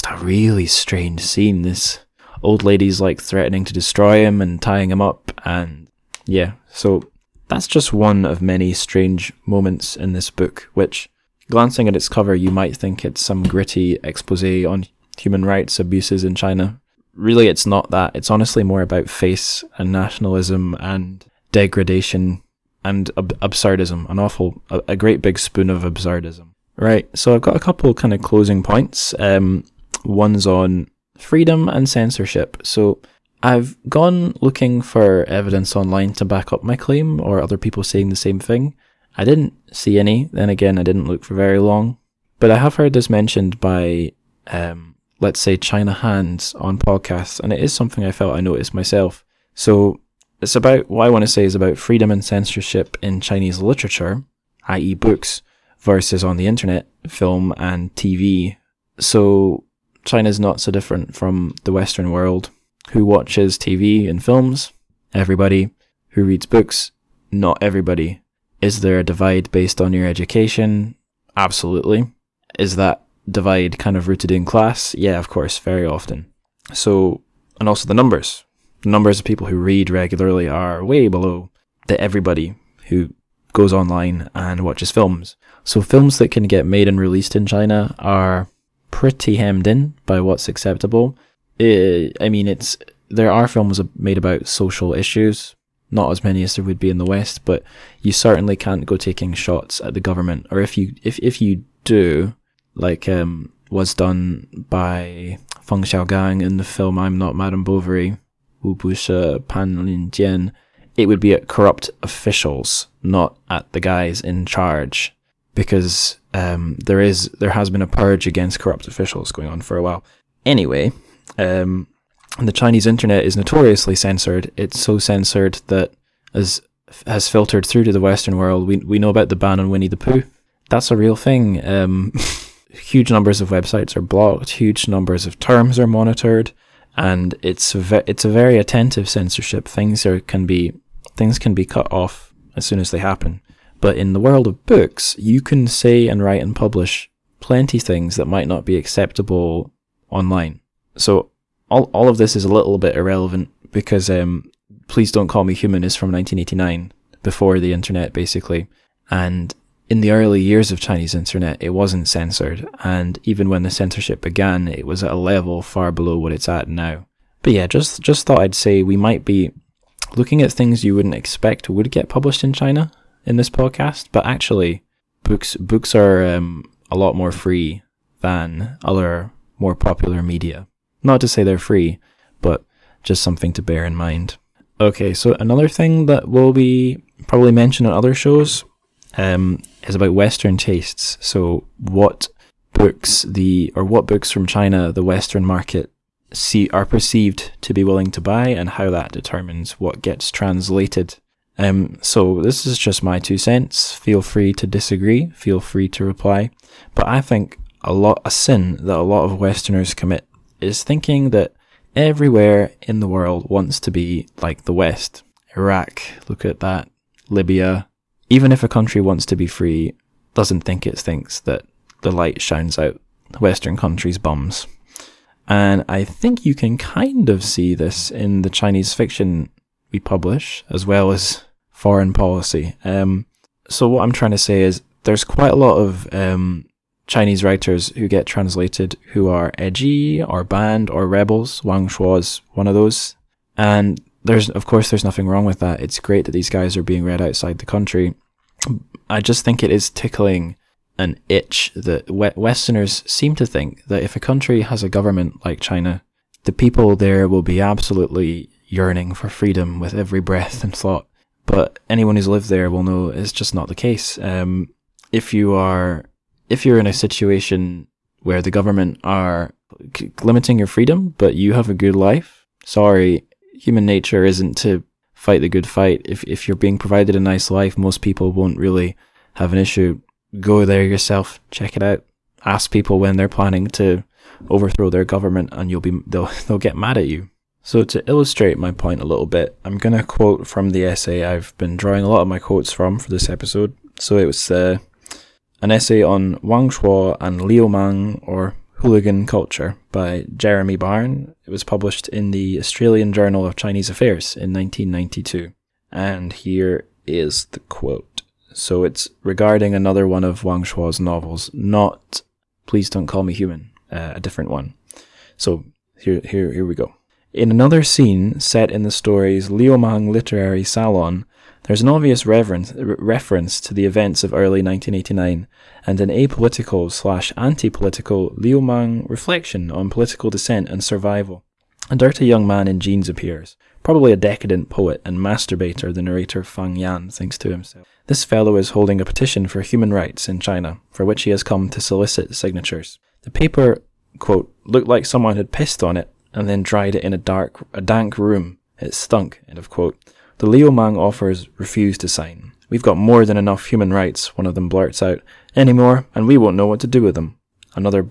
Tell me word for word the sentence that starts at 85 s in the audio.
So films that can get made and released in China are pretty hemmed in by what's acceptable.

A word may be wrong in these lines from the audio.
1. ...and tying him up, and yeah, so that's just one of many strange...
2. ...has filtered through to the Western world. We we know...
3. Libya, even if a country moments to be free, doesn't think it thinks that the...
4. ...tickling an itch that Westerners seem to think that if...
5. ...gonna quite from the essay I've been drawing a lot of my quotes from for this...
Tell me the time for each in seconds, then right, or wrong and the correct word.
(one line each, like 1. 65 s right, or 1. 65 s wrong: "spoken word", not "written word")
1. 4 s right
2. 127 s right
3. 217 s wrong: "wants", not "moments"
4. 249 s right
5. 289 s wrong: "quote", not "quite".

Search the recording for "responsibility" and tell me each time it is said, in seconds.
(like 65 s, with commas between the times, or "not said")
not said.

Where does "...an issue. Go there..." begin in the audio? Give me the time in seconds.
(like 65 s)
279 s.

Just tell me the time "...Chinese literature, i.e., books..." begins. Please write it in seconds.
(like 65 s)
53 s.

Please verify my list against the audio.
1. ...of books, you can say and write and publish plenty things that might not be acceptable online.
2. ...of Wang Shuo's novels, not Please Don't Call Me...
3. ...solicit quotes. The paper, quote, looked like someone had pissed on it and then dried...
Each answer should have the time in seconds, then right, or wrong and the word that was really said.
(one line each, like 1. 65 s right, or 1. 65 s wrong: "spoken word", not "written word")
1. 144 s right
2. 310 s right
3. 341 s wrong: "signatures", not "quotes".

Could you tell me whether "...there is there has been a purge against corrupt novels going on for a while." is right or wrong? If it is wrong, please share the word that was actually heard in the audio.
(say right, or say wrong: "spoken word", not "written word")
wrong: "officials", not "novels".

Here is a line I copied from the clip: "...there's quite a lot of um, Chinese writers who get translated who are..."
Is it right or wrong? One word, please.
right.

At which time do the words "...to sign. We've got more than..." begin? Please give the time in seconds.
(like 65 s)
351 s.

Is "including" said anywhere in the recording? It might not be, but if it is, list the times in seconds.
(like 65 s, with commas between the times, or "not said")
not said.